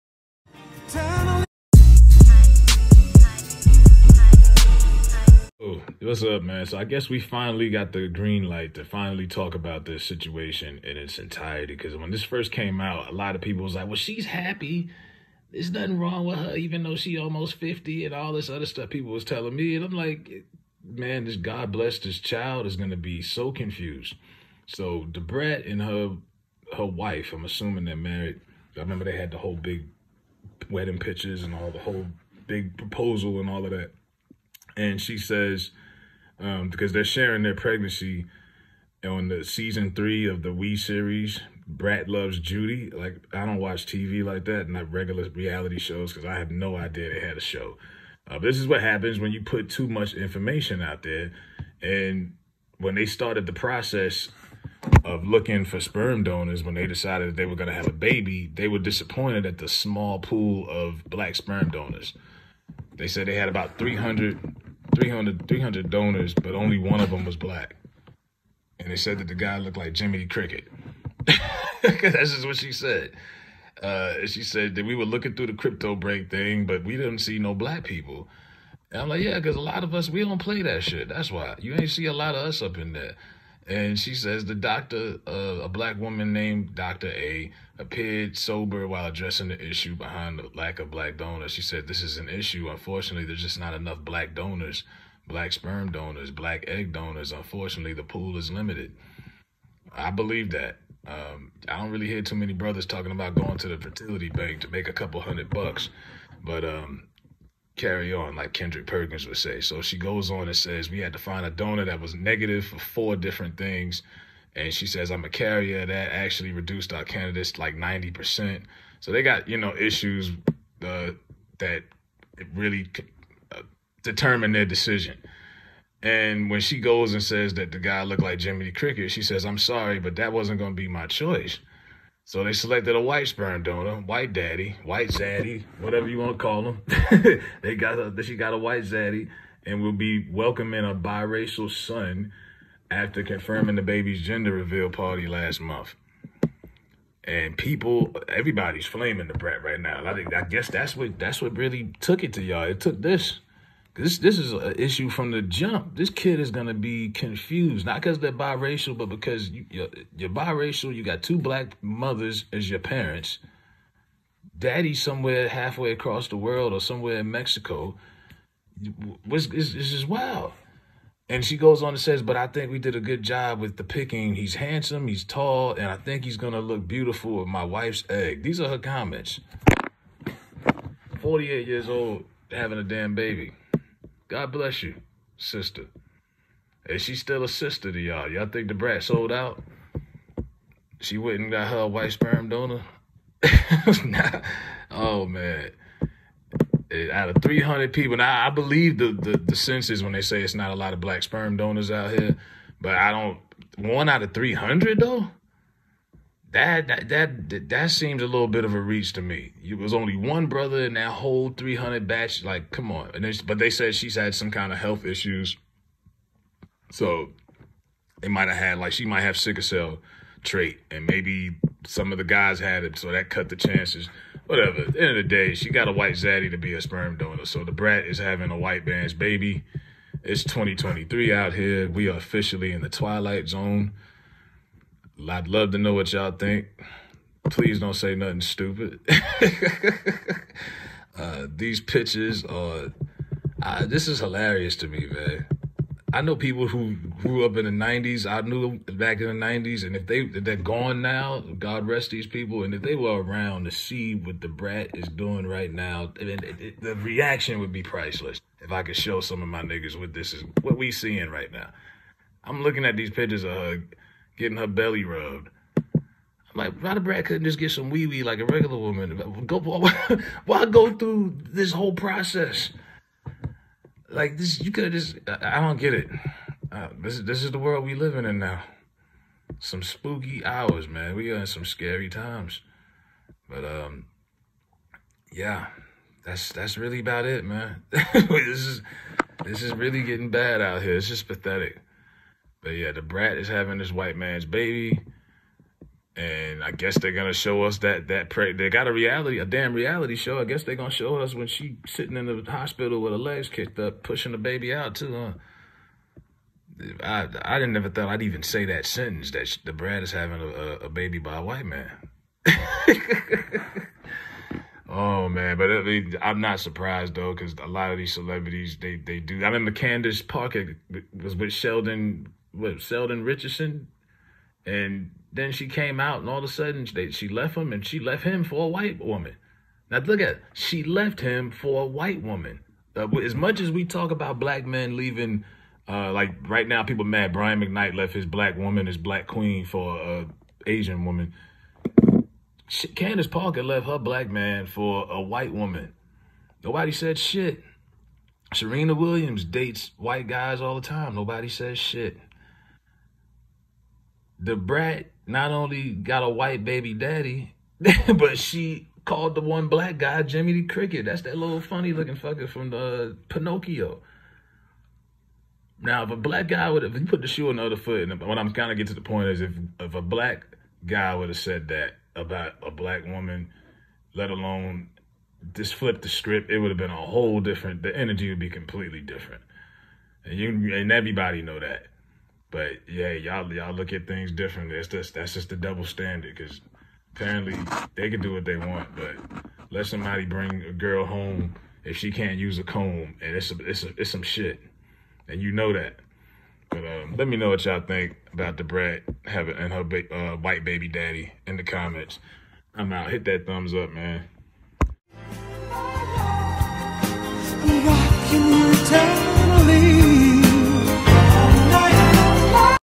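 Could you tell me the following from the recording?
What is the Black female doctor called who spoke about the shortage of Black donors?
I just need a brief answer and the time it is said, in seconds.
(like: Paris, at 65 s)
Dr. A, at 86 s.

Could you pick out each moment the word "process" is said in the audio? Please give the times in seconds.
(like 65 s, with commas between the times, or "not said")
53 s, 271 s.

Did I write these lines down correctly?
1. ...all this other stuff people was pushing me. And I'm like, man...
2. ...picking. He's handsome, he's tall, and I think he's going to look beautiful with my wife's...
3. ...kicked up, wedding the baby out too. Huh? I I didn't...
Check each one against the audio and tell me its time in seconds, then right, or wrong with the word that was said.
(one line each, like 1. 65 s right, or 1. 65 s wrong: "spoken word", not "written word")
1. 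18 s wrong: "telling", not "pushing"
2. 173 s right
3. 303 s wrong: "pushing", not "wedding".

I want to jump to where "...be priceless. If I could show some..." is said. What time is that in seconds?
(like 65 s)
257 s.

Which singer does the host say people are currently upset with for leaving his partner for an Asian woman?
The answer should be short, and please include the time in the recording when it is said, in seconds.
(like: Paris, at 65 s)
Brian McKnight, at 337 s.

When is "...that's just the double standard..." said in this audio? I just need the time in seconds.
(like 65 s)
385 s.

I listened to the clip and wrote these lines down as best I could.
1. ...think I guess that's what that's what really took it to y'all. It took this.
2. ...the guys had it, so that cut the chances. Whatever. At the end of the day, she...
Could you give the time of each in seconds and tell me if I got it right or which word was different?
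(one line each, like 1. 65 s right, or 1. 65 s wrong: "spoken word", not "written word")
1. 150 s right
2. 222 s right.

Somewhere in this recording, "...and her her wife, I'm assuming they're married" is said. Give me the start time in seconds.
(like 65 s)
25 s.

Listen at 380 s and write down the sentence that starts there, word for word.
And you and everybody know that.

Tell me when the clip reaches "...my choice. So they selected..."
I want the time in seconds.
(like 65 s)
130 s.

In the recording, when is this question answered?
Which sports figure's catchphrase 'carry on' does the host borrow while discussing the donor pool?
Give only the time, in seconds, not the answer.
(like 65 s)
108 s.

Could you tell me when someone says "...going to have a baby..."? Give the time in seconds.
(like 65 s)
57 s.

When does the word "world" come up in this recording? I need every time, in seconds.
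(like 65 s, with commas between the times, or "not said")
166 s, 277 s.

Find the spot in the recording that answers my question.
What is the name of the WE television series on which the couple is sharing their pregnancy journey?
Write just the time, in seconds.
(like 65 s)
41 s.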